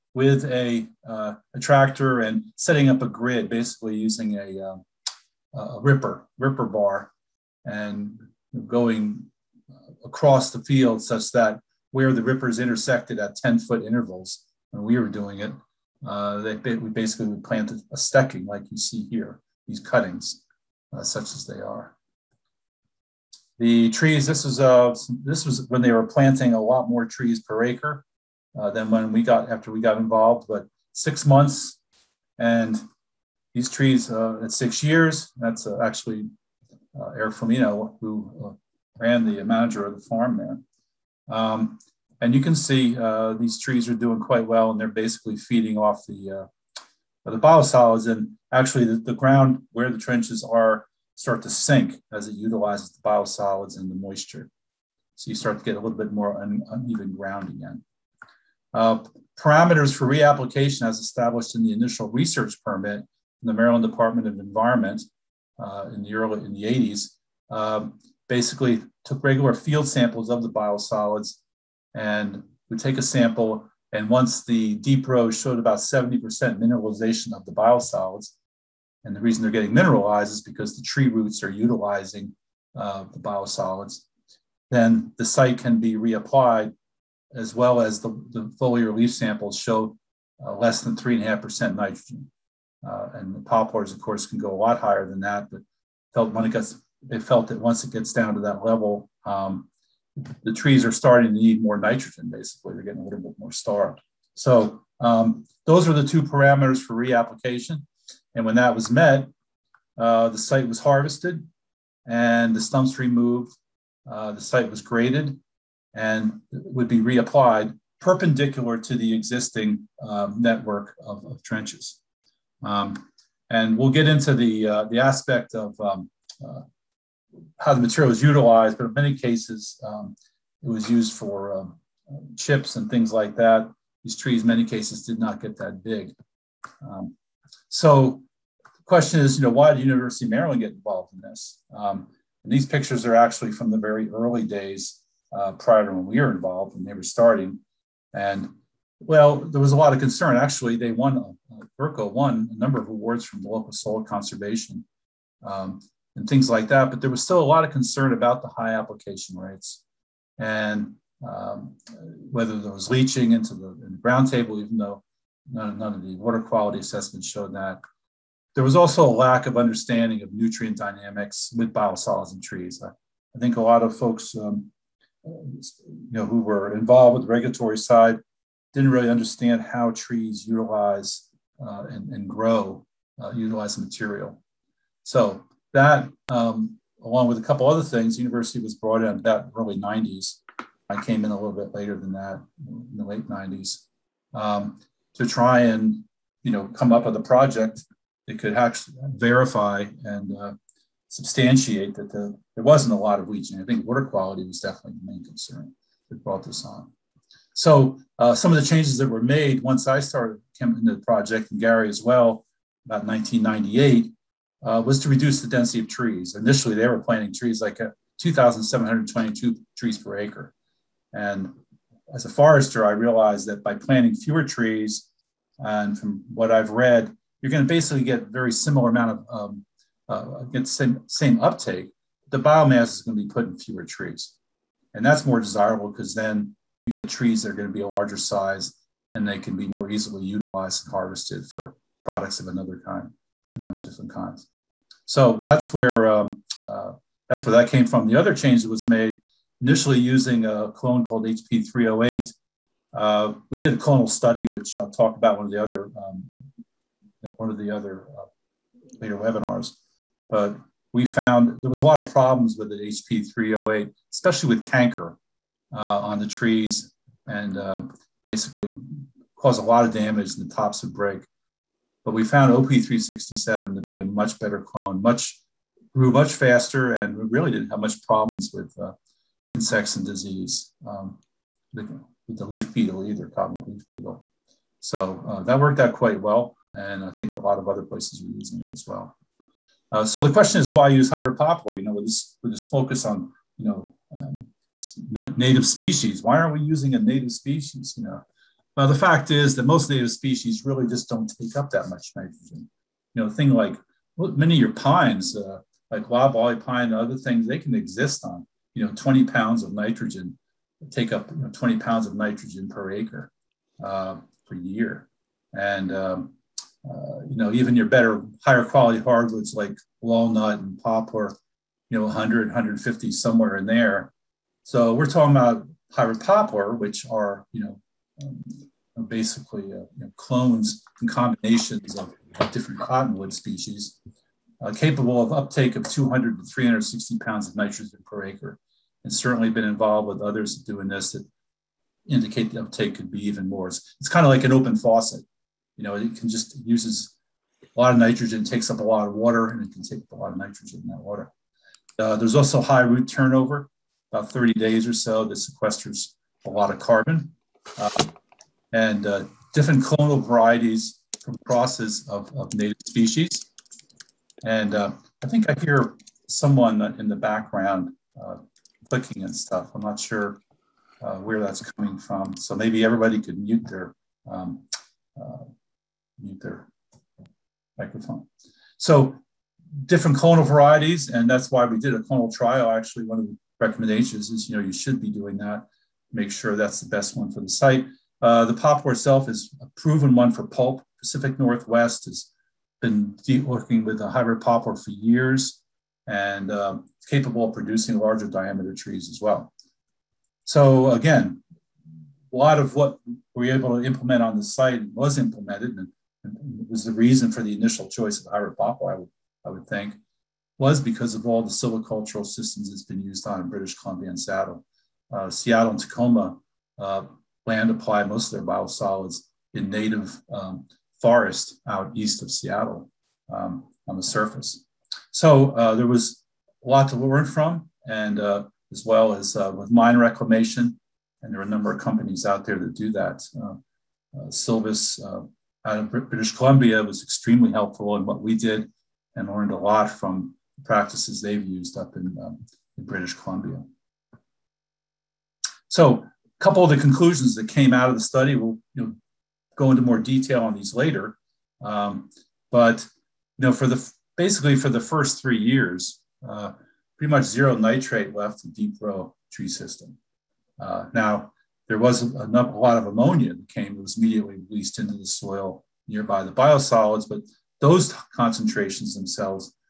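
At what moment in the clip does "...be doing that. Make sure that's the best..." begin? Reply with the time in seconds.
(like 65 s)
384 s.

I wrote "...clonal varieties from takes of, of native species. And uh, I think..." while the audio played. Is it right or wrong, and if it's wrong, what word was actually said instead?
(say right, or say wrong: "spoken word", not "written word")
wrong: "crosses", not "takes".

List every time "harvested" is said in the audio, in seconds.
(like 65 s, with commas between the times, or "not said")
110 s, 240 s.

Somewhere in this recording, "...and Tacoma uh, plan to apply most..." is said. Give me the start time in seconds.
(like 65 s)
415 s.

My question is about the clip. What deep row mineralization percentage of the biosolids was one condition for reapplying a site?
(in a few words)
70%.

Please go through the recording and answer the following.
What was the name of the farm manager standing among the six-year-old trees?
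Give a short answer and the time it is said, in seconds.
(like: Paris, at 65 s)
Eric Flamino, at 37 s.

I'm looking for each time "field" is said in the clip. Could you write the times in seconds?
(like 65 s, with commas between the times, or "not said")
10 s, 69 s.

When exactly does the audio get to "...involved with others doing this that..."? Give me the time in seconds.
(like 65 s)
339 s.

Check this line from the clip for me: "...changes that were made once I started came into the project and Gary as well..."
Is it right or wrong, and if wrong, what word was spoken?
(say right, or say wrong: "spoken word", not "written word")
right.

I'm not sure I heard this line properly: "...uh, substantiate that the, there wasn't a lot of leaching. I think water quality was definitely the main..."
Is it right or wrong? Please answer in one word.
right.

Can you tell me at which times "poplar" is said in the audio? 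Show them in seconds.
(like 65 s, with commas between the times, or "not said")
93 s, 291 s, 320 s, 326 s, 388 s, 394 s, 408 s.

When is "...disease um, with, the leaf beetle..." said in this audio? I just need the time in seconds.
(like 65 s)
280 s.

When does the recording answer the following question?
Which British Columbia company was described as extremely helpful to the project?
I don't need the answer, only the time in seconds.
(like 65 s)
434 s.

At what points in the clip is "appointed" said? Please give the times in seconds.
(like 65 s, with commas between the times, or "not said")
not said.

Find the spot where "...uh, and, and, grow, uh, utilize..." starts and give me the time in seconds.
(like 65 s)
181 s.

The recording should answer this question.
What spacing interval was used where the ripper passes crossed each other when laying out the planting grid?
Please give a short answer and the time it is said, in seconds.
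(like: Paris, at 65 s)
10 foot, at 13 s.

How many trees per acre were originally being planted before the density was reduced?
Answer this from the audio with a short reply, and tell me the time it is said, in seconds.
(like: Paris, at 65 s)
2,722, at 218 s.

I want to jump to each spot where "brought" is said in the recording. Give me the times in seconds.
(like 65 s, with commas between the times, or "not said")
188 s, 206 s.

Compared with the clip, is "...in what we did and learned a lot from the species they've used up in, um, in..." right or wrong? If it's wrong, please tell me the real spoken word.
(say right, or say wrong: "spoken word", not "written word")
wrong: "practices", not "species".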